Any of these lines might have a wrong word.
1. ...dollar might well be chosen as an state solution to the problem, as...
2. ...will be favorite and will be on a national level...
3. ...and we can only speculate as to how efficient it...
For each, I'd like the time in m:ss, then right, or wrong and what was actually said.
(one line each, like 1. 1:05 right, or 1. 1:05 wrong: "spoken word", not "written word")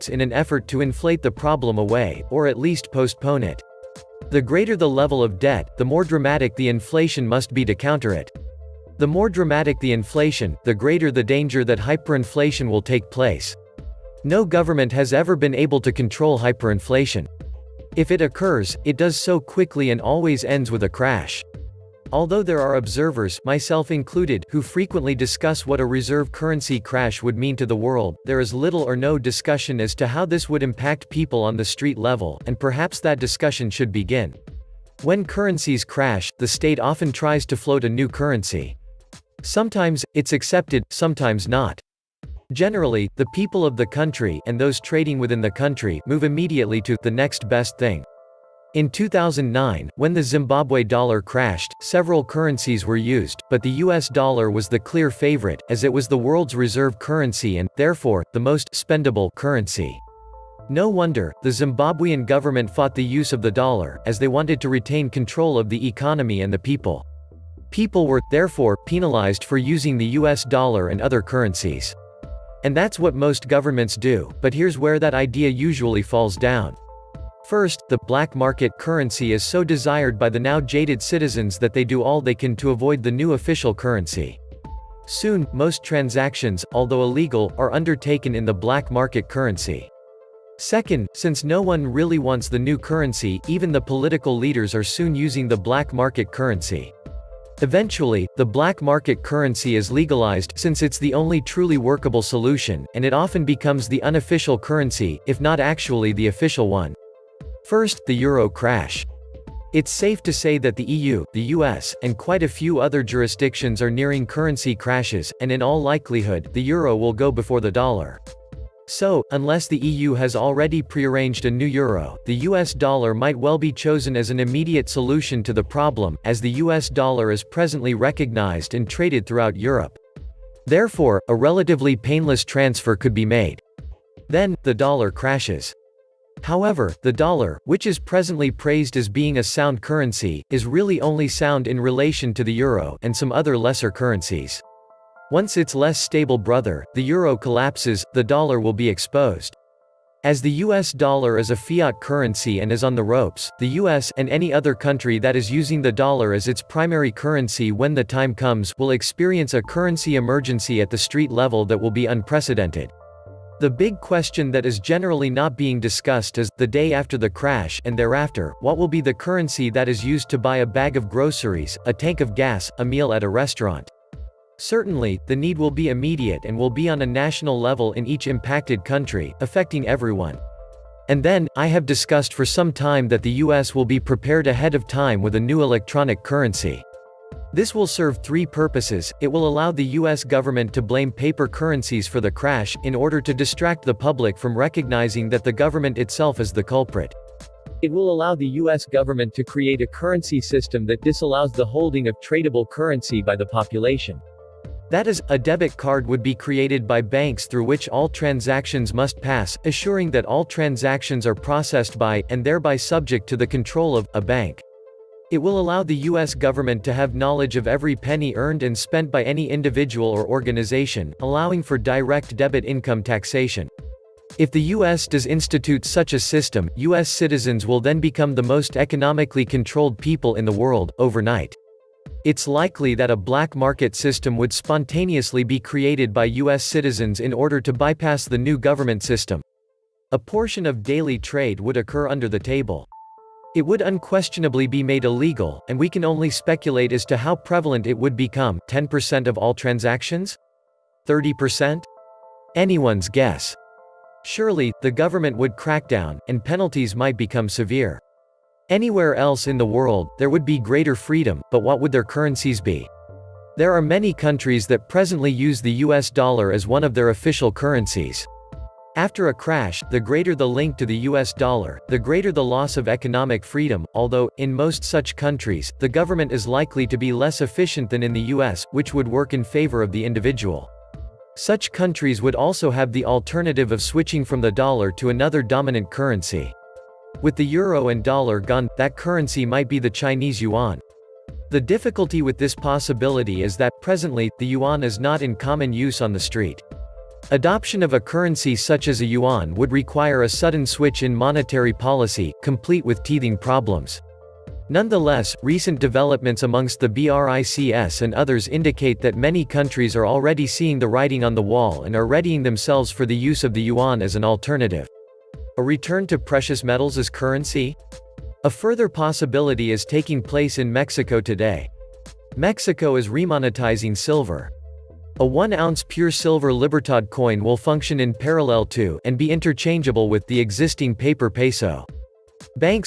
1. 2:02 wrong: "immediate", not "state"
2. 2:55 wrong: "immediate", not "favorite"
3. 4:05 wrong: "prevalent", not "efficient".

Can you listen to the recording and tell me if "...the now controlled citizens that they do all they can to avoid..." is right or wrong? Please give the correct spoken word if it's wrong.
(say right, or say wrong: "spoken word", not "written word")
wrong: "jaded", not "controlled".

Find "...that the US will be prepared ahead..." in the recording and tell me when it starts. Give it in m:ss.
3:03.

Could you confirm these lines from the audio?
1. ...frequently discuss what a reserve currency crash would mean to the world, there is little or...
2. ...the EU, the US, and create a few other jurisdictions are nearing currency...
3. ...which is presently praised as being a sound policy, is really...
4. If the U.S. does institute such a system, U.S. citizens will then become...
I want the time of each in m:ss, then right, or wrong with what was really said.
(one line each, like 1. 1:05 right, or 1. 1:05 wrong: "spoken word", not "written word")
1. 0:24 right
2. 1:50 wrong: "quite", not "create"
3. 2:17 wrong: "currency", not "policy"
4. 3:44 right.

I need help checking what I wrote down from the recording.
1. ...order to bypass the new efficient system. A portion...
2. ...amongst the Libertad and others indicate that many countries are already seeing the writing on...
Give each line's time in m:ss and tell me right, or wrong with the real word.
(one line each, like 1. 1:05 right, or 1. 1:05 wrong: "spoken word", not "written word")
1. 3:57 wrong: "government", not "efficient"
2. 5:06 wrong: "BRICS", not "Libertad".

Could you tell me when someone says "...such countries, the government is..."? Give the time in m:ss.
4:34.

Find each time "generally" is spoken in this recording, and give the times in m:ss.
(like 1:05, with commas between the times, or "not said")
0:42, 2:44.